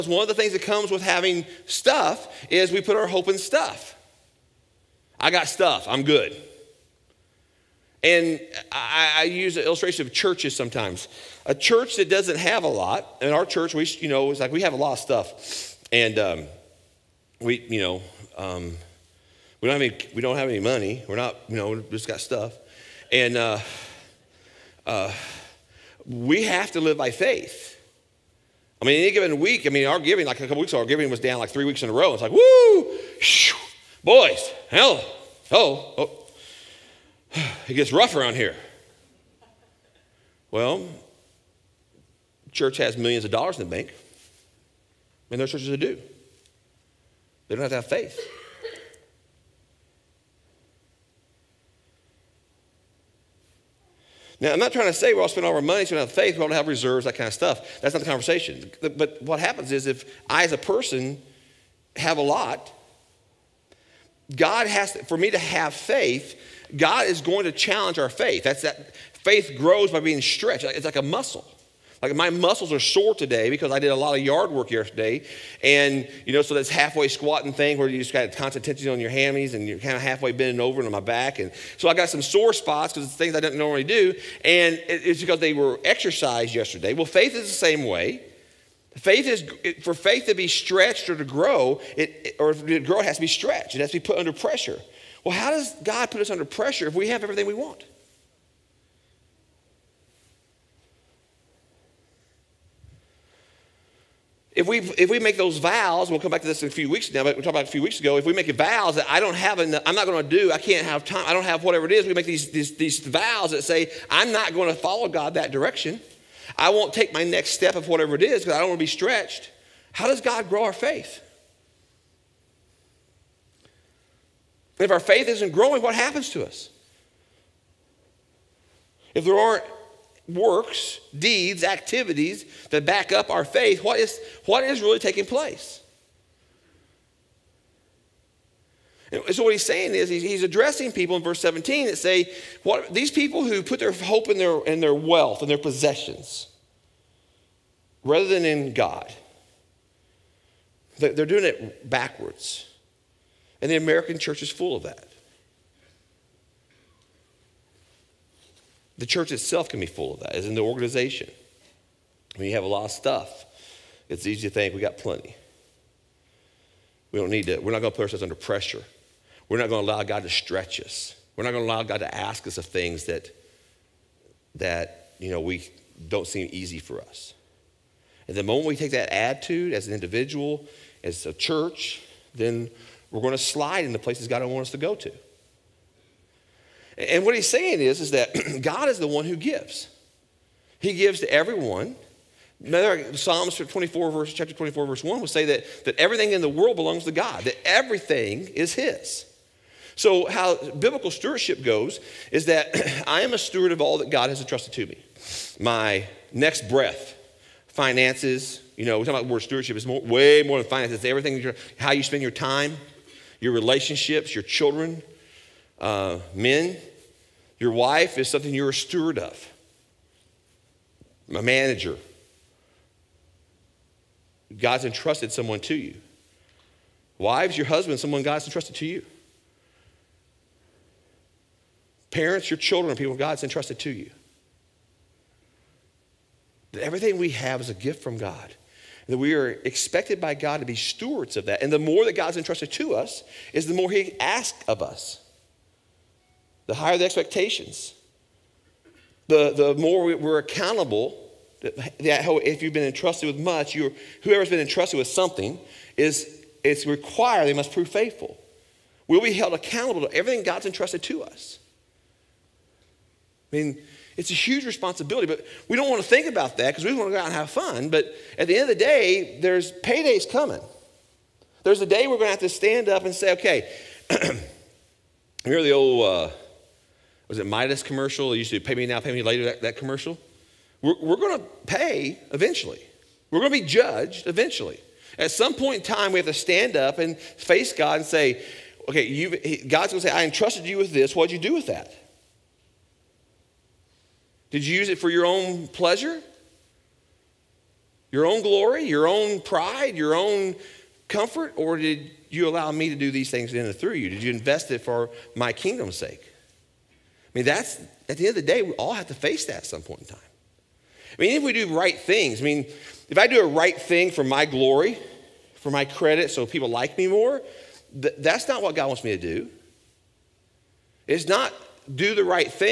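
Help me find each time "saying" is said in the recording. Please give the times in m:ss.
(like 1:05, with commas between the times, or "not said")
2:19, 3:07.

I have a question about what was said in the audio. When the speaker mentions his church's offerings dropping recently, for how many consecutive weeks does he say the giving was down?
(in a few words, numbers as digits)
3.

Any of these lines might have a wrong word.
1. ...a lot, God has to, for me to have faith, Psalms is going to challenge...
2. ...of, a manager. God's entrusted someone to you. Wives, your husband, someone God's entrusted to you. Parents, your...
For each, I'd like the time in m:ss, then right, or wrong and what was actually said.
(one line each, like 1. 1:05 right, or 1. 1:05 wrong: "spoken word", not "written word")
1. 1:02 wrong: "God", not "Psalms"
2. 3:39 right.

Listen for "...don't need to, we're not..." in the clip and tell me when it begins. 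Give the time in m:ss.
2:47.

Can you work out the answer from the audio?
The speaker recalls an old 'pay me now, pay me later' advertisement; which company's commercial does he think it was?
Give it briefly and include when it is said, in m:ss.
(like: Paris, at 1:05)
Midas, at 4:37.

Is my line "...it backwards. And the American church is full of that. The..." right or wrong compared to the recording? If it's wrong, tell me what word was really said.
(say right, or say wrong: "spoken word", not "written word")
right.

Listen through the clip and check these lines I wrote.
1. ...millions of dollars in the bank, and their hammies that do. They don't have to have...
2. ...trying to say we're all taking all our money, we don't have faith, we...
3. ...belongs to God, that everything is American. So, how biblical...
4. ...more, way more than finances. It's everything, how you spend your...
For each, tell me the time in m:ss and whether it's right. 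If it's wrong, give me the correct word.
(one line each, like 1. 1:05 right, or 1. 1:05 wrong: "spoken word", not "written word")
1. 0:42 wrong: "churches", not "hammies"
2. 0:54 wrong: "spending", not "taking"
3. 3:16 wrong: "His", not "American"
4. 3:29 right.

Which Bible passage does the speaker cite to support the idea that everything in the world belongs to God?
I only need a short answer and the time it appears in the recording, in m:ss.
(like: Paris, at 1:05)
Psalms 24:1, at 3:13.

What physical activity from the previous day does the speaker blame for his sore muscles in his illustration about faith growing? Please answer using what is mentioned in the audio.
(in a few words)
Yard work.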